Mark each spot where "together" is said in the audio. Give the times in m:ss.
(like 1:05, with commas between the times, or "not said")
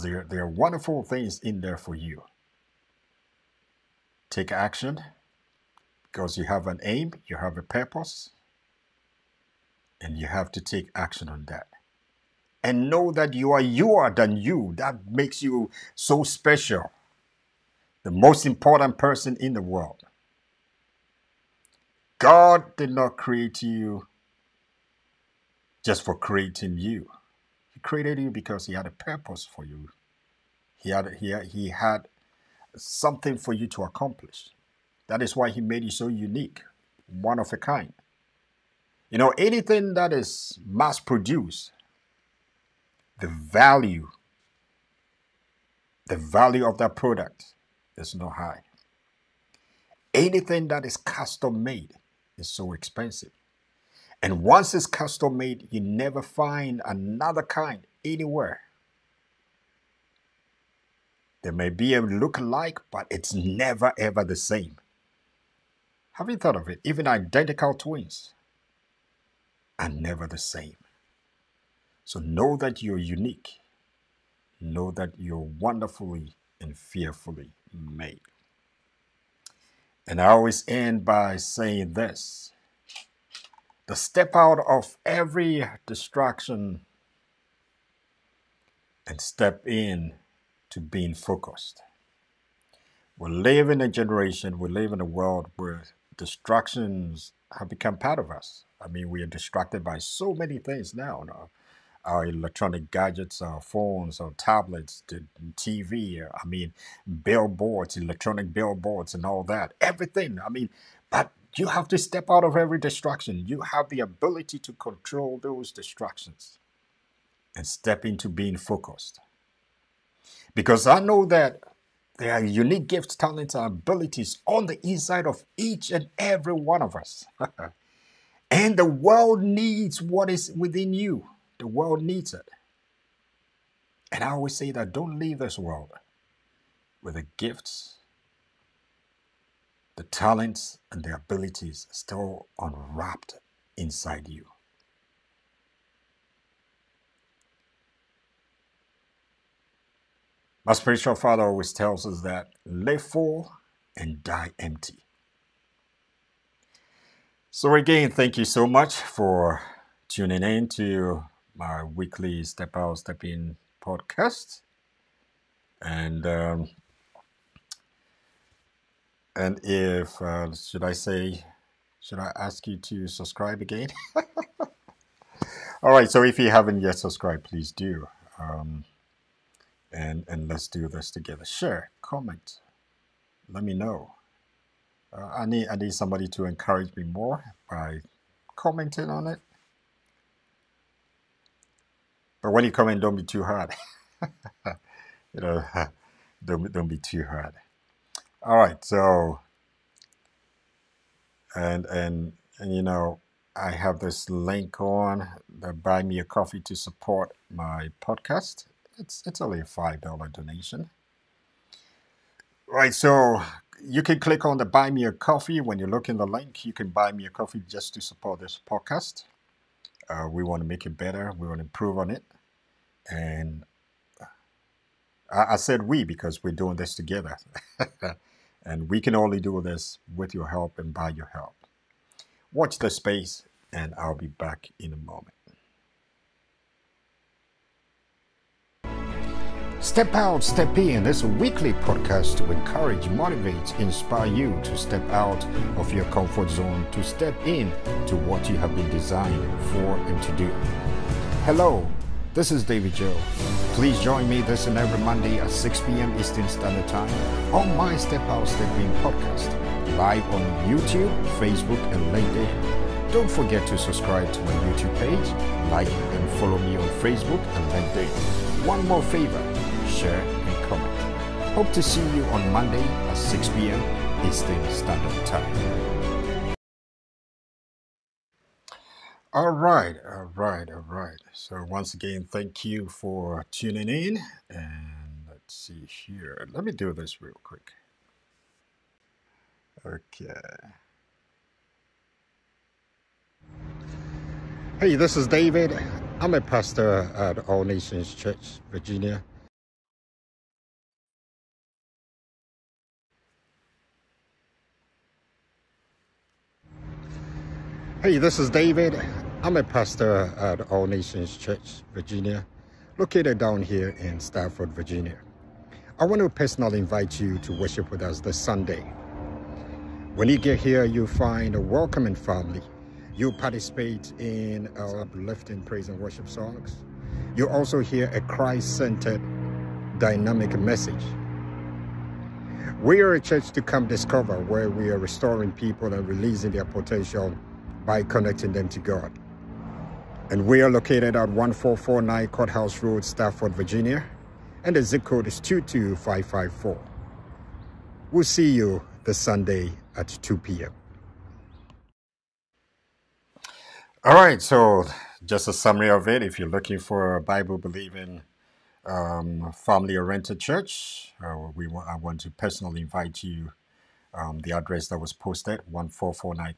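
3:01, 3:46.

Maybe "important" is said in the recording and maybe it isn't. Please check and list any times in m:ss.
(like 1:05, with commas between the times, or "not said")
0:18.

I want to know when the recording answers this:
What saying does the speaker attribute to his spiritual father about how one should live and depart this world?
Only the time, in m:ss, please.
2:32.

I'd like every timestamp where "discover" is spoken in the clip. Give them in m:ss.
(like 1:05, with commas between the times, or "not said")
5:33.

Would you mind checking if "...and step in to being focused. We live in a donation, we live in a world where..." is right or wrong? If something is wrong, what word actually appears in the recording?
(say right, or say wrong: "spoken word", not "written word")
wrong: "generation", not "donation".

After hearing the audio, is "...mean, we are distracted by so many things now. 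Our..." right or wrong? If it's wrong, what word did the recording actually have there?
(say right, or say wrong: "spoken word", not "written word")
right.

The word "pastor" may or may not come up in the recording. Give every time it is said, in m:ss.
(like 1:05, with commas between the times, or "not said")
4:56, 5:09.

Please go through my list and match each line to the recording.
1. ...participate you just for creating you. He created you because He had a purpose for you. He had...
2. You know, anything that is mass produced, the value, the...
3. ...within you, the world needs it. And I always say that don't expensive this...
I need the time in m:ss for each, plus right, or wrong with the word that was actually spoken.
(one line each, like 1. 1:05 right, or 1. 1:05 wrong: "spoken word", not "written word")
1. 0:23 wrong: "create", not "participate"
2. 0:39 right
3. 2:10 wrong: "leave", not "expensive".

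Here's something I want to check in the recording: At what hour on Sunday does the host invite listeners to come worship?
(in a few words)
2 p.m.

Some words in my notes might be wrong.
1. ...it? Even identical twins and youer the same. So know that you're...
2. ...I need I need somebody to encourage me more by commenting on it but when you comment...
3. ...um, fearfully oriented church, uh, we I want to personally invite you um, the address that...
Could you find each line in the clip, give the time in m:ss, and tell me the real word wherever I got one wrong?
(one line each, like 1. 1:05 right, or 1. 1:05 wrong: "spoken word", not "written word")
1. 1:06 wrong: "never", not "youer"
2. 3:05 right
3. 5:58 wrong: "family", not "fearfully".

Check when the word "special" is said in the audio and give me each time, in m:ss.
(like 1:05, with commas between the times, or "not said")
0:16.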